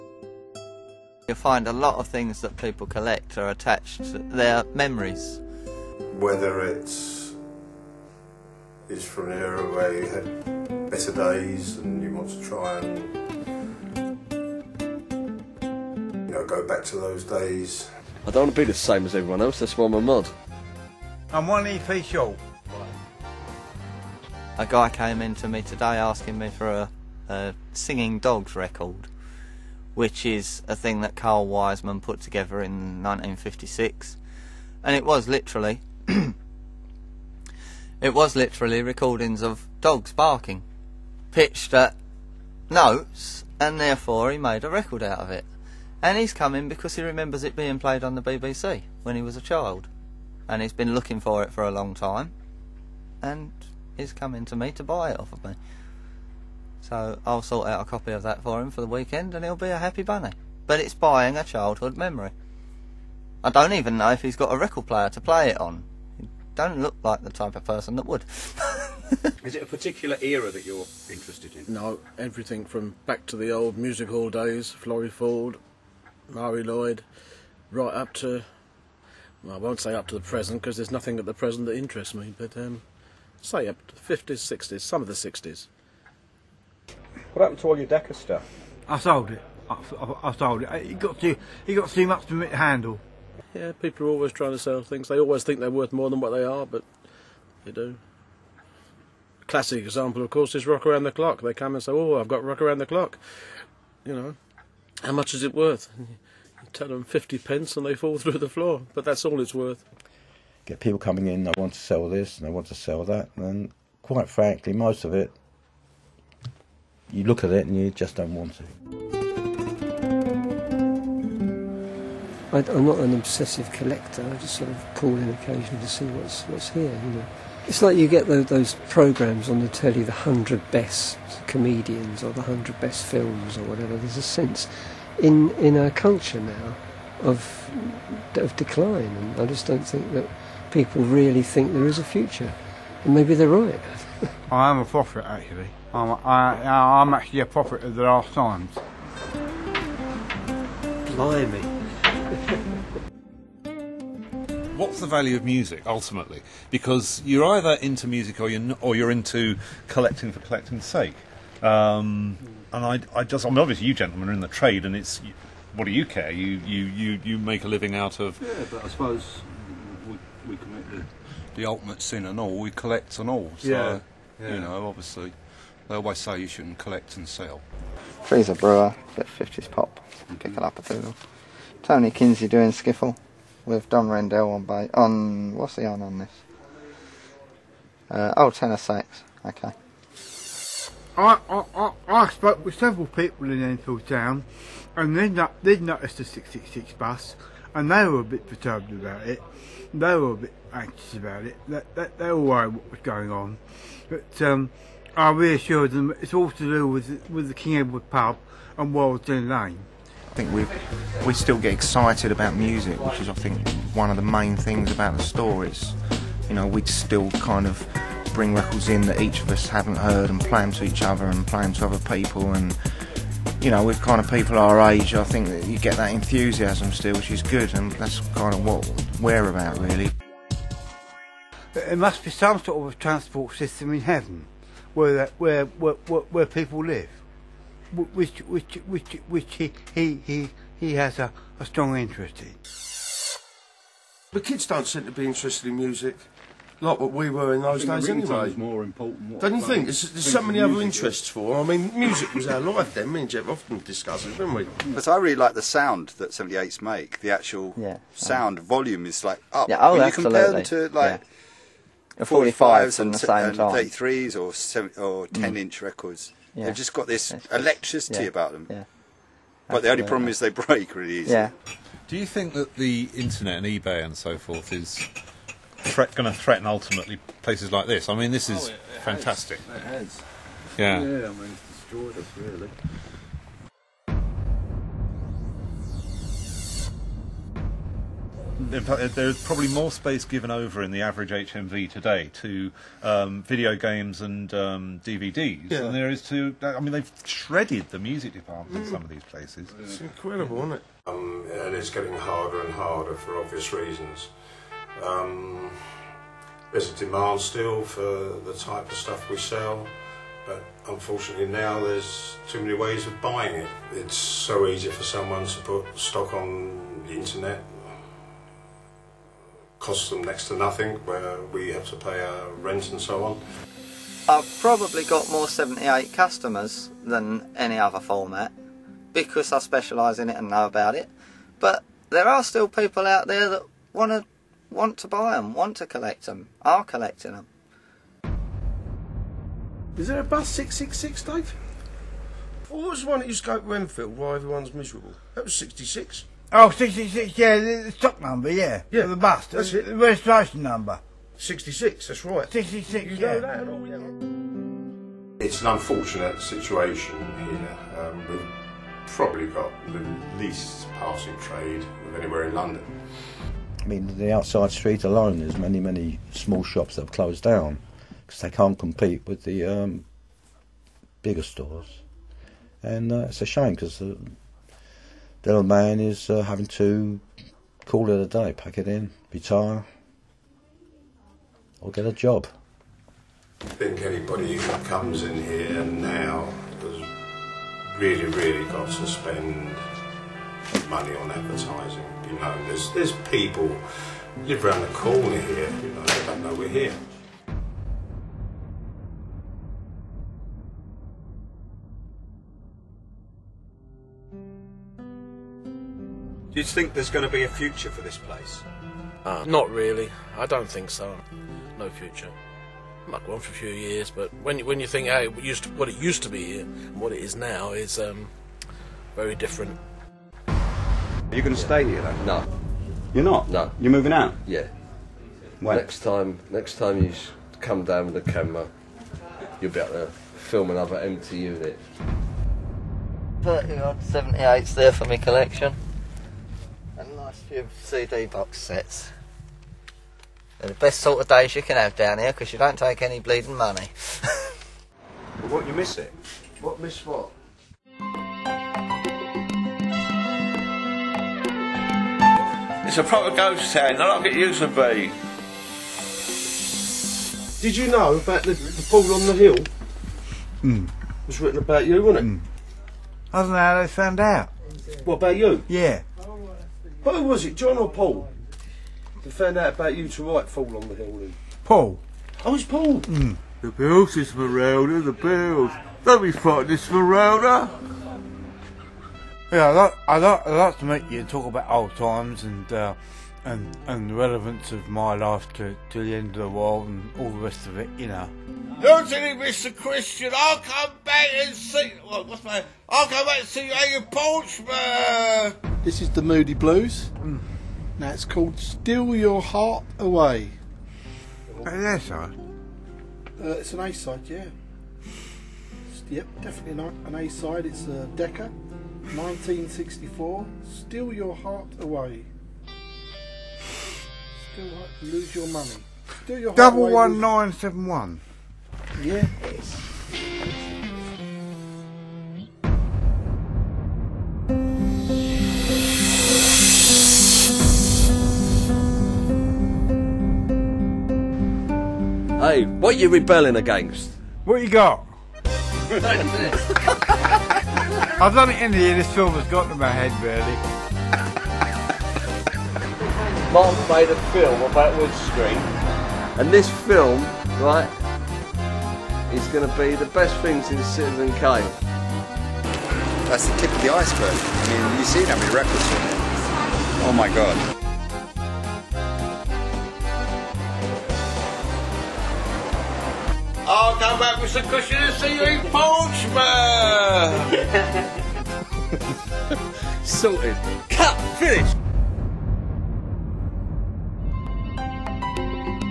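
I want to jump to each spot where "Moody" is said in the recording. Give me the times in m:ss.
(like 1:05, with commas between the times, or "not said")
8:16.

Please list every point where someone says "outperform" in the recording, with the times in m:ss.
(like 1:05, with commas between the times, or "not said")
not said.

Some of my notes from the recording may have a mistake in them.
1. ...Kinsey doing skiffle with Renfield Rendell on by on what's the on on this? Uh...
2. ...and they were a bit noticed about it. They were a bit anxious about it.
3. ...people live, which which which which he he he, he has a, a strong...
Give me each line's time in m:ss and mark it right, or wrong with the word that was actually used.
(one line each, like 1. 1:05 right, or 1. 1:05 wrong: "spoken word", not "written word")
1. 3:02 wrong: "Don", not "Renfield"
2. 3:17 wrong: "perturbed", not "noticed"
3. 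3:56 right.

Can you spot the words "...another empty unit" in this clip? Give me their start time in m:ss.
7:10.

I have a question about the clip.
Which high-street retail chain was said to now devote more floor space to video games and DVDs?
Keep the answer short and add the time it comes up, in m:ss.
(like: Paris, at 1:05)
HMV, at 4:51.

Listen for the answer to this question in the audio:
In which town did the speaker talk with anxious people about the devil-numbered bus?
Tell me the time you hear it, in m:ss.
3:13.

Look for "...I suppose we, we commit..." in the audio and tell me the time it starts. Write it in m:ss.
2:48.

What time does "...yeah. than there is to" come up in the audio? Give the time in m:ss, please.
4:55.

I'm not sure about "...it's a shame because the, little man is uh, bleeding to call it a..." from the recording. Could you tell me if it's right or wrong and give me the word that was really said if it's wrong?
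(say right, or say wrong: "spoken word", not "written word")
wrong: "having", not "bleeding".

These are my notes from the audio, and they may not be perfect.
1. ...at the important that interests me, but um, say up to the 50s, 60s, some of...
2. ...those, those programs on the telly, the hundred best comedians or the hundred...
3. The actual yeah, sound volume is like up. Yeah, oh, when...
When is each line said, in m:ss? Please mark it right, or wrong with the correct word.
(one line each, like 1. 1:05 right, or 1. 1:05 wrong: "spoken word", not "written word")
1. 1:21 wrong: "present", not "important"
2. 2:08 right
3. 4:17 right.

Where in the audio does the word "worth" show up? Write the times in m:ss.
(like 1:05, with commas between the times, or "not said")
1:35, 1:45, 1:49.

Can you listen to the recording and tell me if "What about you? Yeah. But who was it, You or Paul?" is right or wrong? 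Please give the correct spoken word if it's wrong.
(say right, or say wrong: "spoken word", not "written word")
wrong: "John", not "You".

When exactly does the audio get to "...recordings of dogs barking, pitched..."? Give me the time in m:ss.
0:38.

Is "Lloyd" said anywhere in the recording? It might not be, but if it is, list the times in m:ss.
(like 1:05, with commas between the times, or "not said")
1:16.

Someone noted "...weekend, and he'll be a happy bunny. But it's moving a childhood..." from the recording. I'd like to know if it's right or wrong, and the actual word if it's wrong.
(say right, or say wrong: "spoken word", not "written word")
wrong: "buying", not "moving".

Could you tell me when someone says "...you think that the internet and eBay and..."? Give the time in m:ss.
4:32.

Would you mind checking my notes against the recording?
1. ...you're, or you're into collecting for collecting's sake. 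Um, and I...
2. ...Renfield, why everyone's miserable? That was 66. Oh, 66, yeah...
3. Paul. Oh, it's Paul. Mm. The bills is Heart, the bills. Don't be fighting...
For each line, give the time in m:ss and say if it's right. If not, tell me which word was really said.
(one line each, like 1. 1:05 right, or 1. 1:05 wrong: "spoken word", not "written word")
1. 2:38 right
2. 5:43 right
3. 7:51 wrong: "Marauder", not "Heart".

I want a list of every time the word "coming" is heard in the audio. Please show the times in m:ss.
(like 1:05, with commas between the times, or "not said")
0:46, 0:54, 1:50.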